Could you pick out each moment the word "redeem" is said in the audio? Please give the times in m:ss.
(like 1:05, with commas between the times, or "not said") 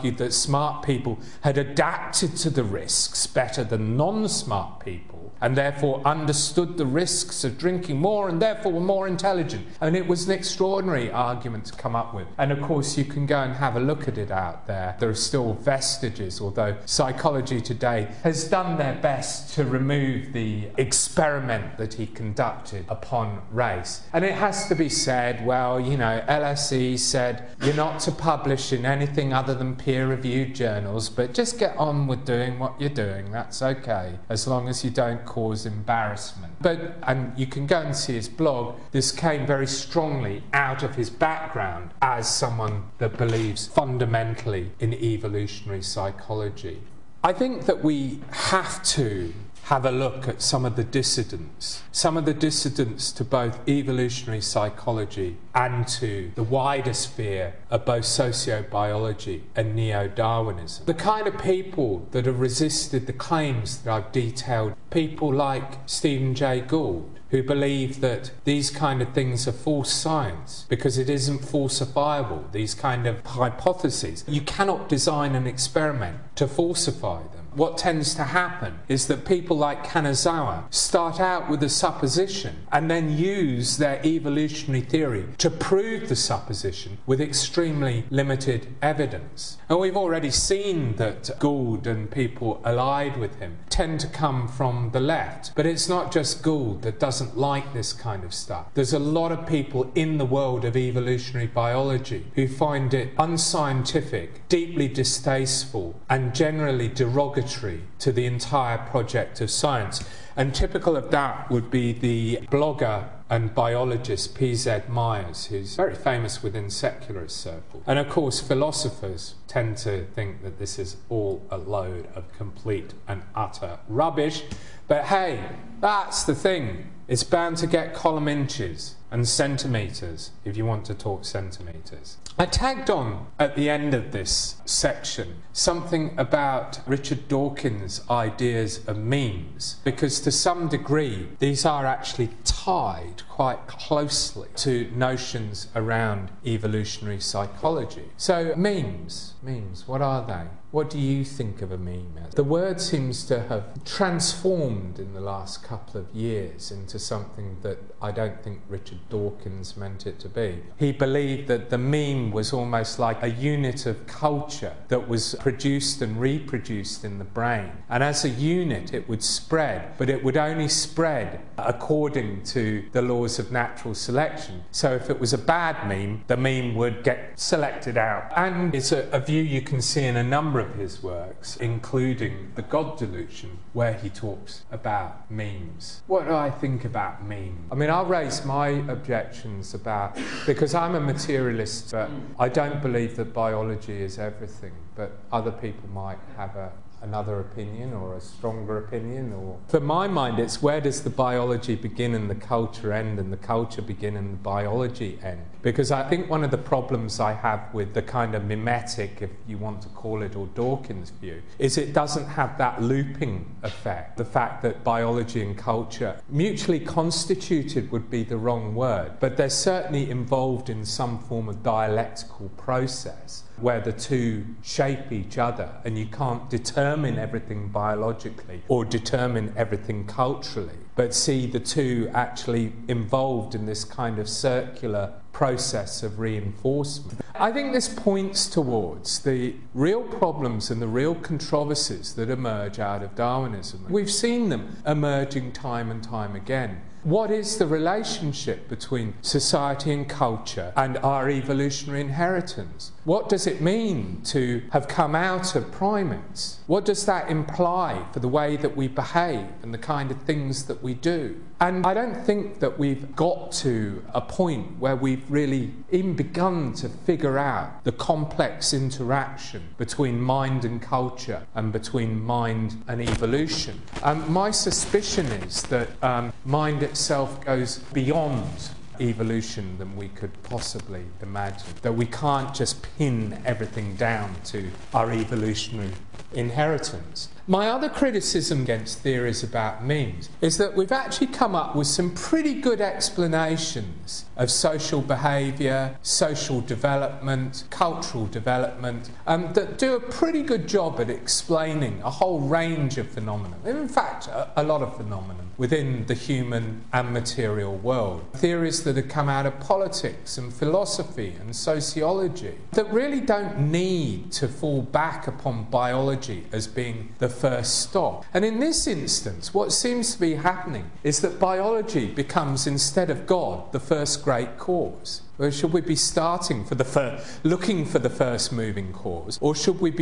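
not said.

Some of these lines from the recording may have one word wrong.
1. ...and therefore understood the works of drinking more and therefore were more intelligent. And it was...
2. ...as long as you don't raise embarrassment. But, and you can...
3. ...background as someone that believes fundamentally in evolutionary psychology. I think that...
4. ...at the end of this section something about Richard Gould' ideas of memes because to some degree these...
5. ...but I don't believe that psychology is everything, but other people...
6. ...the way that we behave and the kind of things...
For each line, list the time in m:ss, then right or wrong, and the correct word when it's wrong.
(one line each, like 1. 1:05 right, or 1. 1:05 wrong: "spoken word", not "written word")
1. 0:05 wrong: "risks", not "works"
2. 0:34 wrong: "cause", not "raise"
3. 0:41 right
4. 2:13 wrong: "Dawkins", not "Gould"
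5. 3:11 wrong: "biology", not "psychology"
6. 4:18 right.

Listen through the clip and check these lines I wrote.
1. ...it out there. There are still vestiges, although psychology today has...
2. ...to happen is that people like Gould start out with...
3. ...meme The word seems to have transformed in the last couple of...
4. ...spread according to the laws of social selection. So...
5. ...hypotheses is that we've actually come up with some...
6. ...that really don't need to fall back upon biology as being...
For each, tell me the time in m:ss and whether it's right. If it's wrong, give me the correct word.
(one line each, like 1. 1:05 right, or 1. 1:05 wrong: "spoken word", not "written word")
1. 0:14 right
2. 1:18 wrong: "Kanazawa", not "Gould"
3. 2:31 right
4. 2:50 wrong: "natural", not "social"
5. 4:49 wrong: "memes", not "hypotheses"
6. 5:12 right.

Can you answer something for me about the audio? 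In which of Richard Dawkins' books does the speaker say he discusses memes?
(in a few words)
The God Delusion.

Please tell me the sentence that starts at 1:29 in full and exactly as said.
And we've already seen that Gould and people allied with him tend to come from the left.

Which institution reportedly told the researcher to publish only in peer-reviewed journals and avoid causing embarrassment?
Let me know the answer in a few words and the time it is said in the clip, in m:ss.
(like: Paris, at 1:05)
LSE, at 0:26.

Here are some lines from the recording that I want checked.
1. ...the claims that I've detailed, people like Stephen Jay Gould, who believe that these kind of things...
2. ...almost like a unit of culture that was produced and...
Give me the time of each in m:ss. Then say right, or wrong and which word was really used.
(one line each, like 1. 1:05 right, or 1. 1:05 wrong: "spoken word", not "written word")
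1. 1:03 right
2. 2:42 right.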